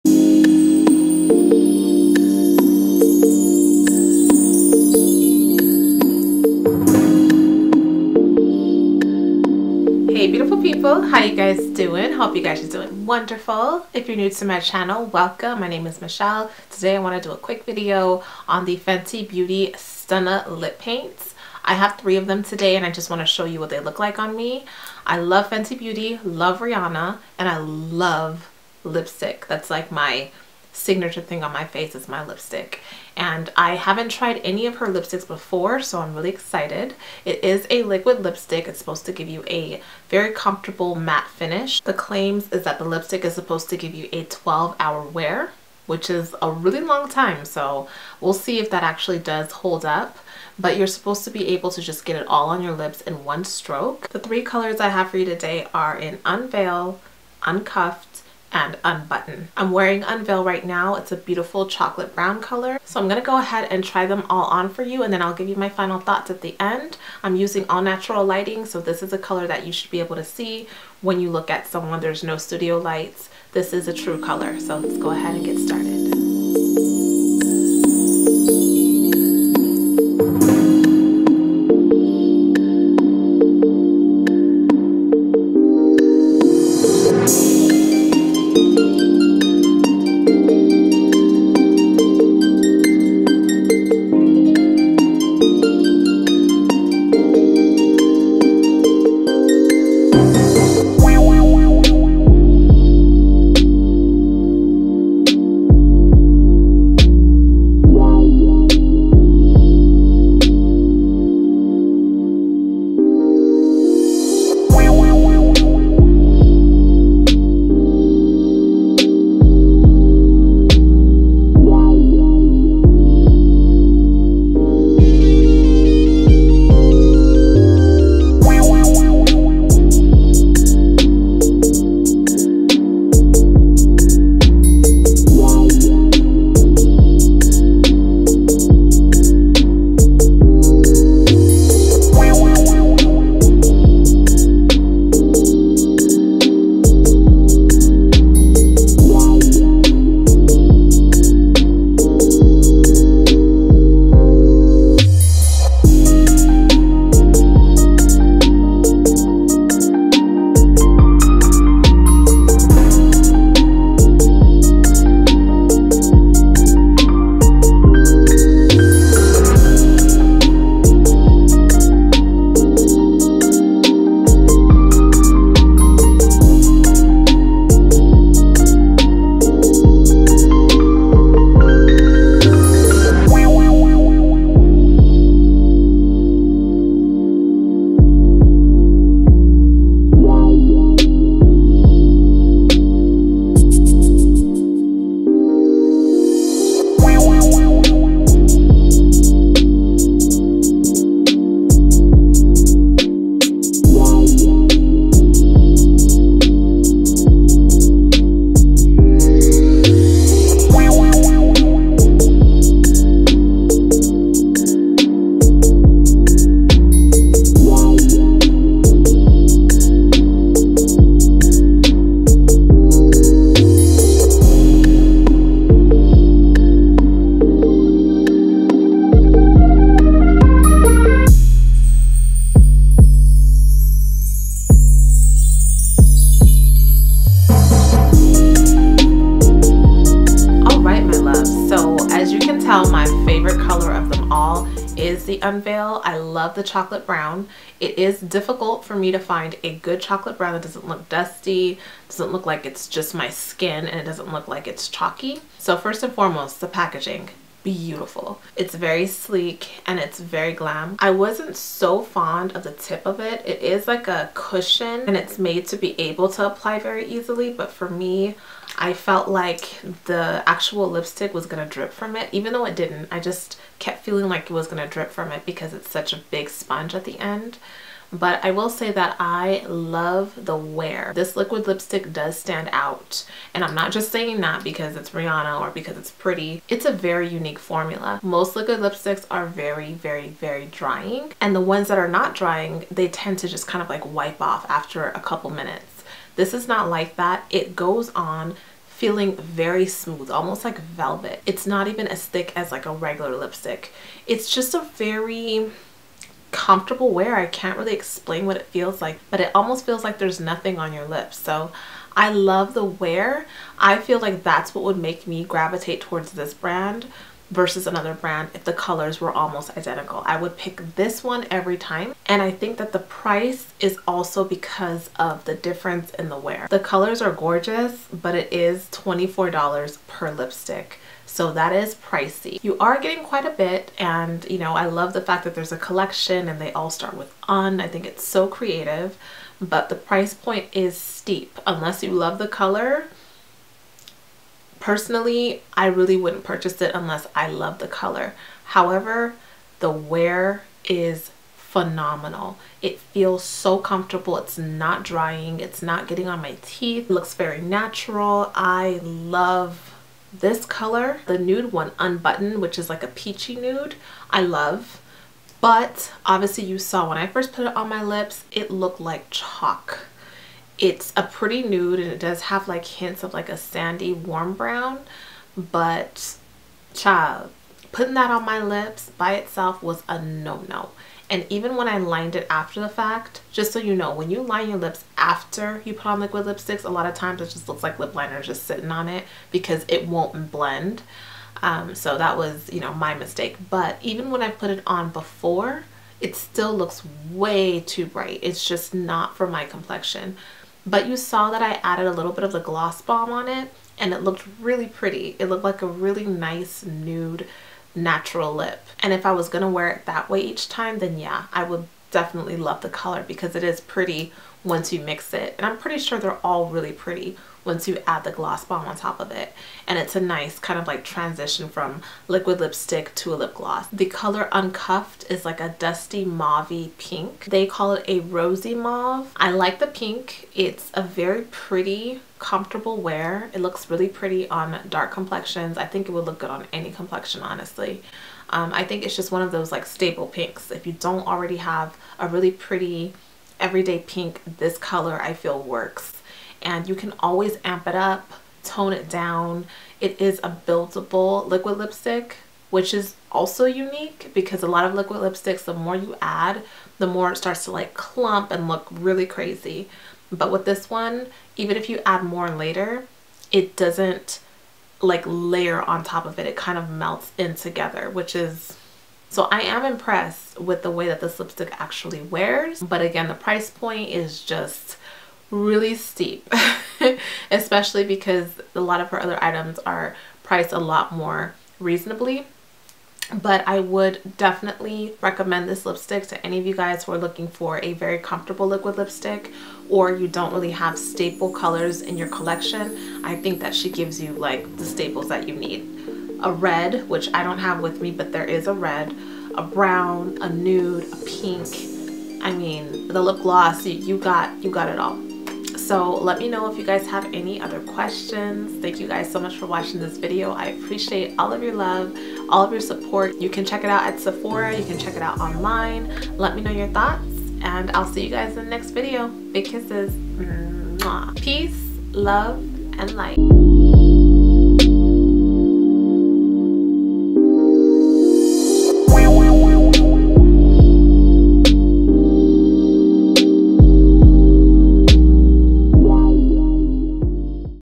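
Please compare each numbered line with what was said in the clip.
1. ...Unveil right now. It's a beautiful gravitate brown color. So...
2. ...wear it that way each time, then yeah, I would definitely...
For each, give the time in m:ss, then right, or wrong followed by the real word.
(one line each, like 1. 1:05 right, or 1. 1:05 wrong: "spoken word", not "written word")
1. 1:00 wrong: "chocolate", not "gravitate"
2. 6:49 right.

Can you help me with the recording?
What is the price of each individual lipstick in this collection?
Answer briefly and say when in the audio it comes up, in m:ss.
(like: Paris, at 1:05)
$24, at 5:28.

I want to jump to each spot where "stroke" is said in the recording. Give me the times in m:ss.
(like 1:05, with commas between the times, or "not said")
0:53.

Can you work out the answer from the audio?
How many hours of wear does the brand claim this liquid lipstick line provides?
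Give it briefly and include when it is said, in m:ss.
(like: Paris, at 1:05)
12, at 0:44.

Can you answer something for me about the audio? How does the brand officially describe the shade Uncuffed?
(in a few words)
rosy mauve.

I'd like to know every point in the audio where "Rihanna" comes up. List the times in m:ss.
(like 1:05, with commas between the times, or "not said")
0:26, 4:45.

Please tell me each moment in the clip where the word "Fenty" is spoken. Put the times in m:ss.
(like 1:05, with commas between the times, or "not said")
0:18, 0:25.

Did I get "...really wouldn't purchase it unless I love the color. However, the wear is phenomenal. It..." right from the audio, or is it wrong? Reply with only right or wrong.
right.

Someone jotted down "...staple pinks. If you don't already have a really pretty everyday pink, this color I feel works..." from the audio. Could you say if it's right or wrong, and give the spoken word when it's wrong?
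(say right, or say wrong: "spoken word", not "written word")
right.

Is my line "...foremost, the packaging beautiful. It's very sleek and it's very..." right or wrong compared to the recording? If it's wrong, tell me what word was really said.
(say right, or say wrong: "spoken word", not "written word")
right.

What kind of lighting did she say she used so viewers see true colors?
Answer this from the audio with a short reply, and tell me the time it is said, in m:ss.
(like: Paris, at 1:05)
natural lighting, at 1:07.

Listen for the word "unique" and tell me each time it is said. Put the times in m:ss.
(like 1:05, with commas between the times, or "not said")
4:47, 7:33.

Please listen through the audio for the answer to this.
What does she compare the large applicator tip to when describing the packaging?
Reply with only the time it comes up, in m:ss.
4:24.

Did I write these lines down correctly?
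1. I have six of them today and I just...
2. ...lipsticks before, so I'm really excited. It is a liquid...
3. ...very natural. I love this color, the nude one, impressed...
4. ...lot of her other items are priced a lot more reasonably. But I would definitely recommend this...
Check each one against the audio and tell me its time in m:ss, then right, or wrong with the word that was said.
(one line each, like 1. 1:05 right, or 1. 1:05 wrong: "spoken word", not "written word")
1. 0:21 wrong: "three", not "six"
2. 0:34 right
3. 5:57 wrong: "unbuttoned", not "impressed"
4. 7:58 right.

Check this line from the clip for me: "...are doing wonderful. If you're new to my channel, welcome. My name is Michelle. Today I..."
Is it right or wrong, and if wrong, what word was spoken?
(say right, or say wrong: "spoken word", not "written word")
right.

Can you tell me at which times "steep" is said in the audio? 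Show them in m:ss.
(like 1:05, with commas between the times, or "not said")
5:40, 7:55.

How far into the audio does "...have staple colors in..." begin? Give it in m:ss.
8:10.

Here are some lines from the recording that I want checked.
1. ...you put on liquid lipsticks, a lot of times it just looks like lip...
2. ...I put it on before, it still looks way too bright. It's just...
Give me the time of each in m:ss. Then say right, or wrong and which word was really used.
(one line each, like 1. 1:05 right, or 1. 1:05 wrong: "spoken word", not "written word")
1. 6:25 right
2. 6:34 right.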